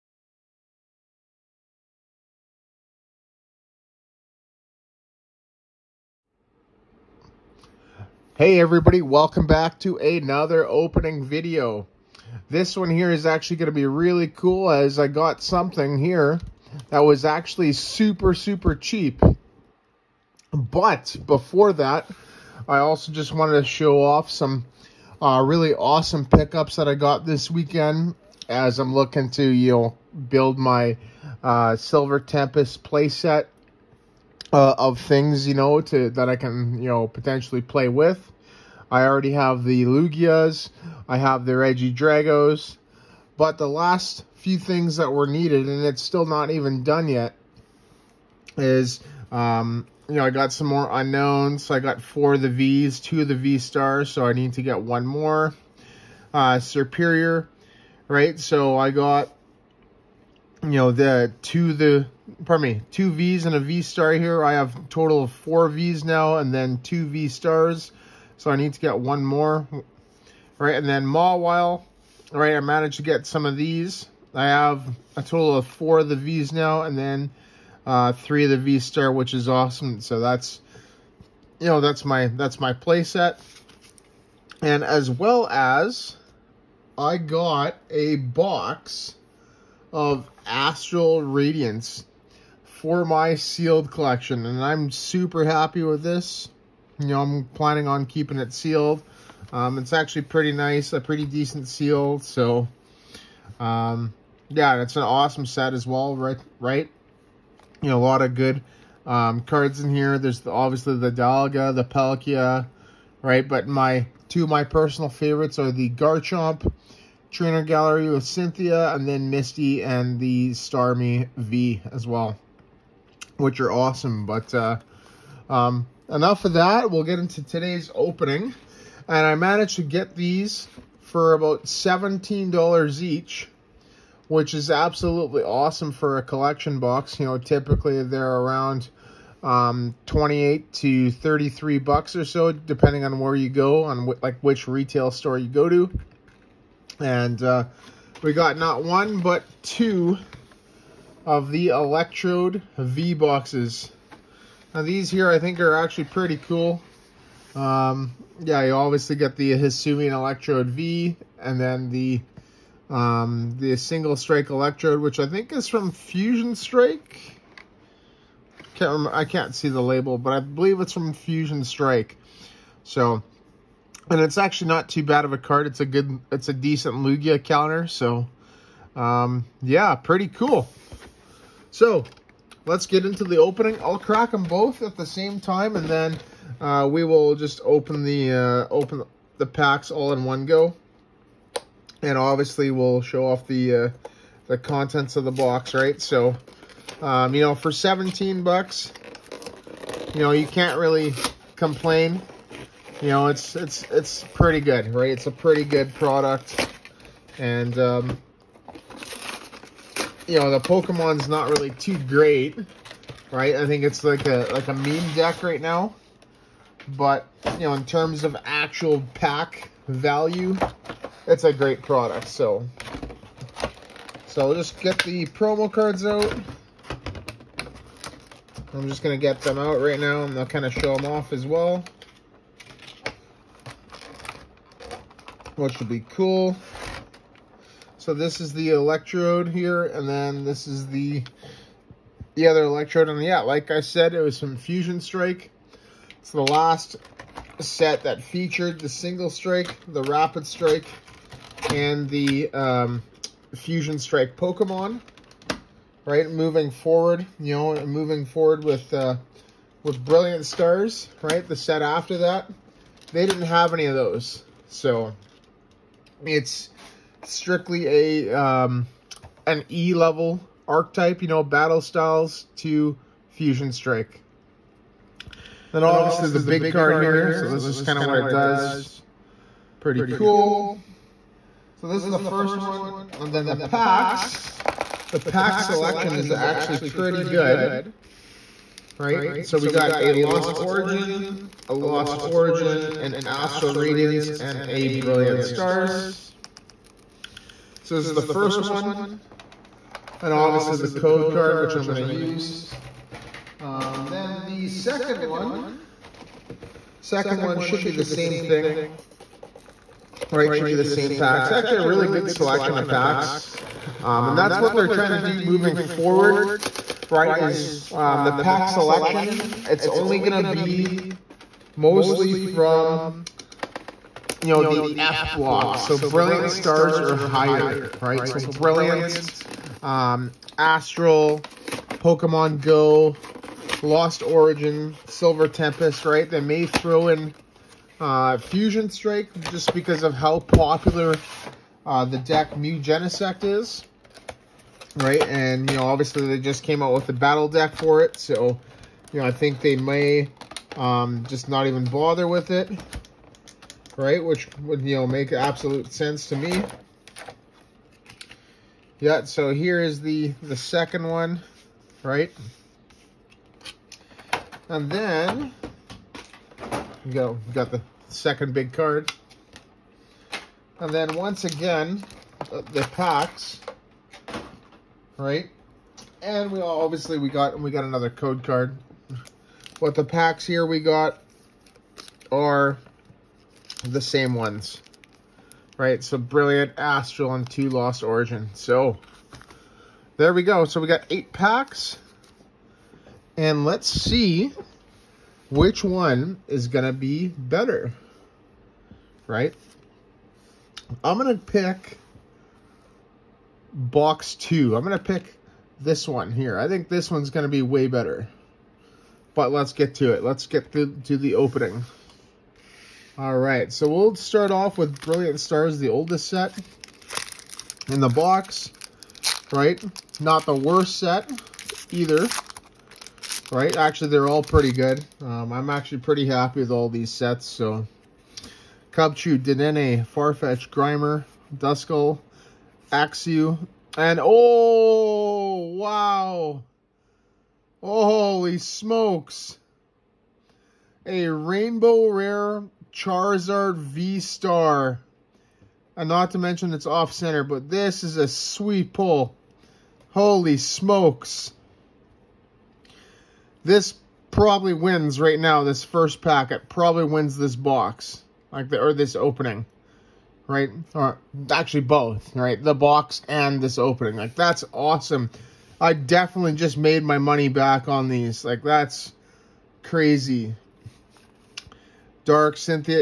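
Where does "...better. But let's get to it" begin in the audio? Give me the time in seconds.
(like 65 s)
407 s.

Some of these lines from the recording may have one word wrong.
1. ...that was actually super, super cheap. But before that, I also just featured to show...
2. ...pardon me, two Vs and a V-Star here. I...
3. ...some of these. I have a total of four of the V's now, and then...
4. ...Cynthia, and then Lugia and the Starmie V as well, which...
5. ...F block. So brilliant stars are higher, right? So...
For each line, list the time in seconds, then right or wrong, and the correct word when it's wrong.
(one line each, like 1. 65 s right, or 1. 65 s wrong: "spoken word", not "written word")
1. 16 s wrong: "wanted", not "featured"
2. 62 s right
3. 73 s right
4. 118 s wrong: "Misty", not "Lugia"
5. 324 s right.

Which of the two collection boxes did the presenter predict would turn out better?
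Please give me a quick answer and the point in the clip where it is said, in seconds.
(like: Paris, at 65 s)
box 2, at 403 s.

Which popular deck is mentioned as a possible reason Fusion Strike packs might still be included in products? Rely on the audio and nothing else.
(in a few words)
Mew Genesect.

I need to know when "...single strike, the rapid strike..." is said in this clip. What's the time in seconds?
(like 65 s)
248 s.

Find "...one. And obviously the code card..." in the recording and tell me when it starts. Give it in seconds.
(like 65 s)
298 s.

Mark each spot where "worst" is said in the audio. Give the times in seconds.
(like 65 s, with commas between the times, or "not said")
420 s.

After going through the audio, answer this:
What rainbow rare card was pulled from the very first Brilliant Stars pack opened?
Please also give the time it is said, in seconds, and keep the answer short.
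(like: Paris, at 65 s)
Charizard V-Star, at 442 s.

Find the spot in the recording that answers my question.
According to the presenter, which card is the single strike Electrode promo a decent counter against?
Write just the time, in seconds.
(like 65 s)
176 s.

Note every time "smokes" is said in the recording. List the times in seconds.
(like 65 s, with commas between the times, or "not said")
438 s, 450 s.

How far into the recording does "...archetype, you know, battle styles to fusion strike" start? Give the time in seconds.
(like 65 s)
270 s.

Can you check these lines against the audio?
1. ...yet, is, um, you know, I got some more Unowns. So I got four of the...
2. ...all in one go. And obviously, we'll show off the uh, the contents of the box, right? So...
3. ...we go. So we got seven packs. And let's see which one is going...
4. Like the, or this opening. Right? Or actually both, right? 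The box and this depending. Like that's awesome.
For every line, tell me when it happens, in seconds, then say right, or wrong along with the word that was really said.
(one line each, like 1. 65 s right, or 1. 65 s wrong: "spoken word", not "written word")
1. 47 s right
2. 189 s right
3. 390 s wrong: "eight", not "seven"
4. 458 s wrong: "opening", not "depending".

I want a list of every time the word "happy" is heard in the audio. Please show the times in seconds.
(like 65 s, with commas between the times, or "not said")
95 s, 426 s.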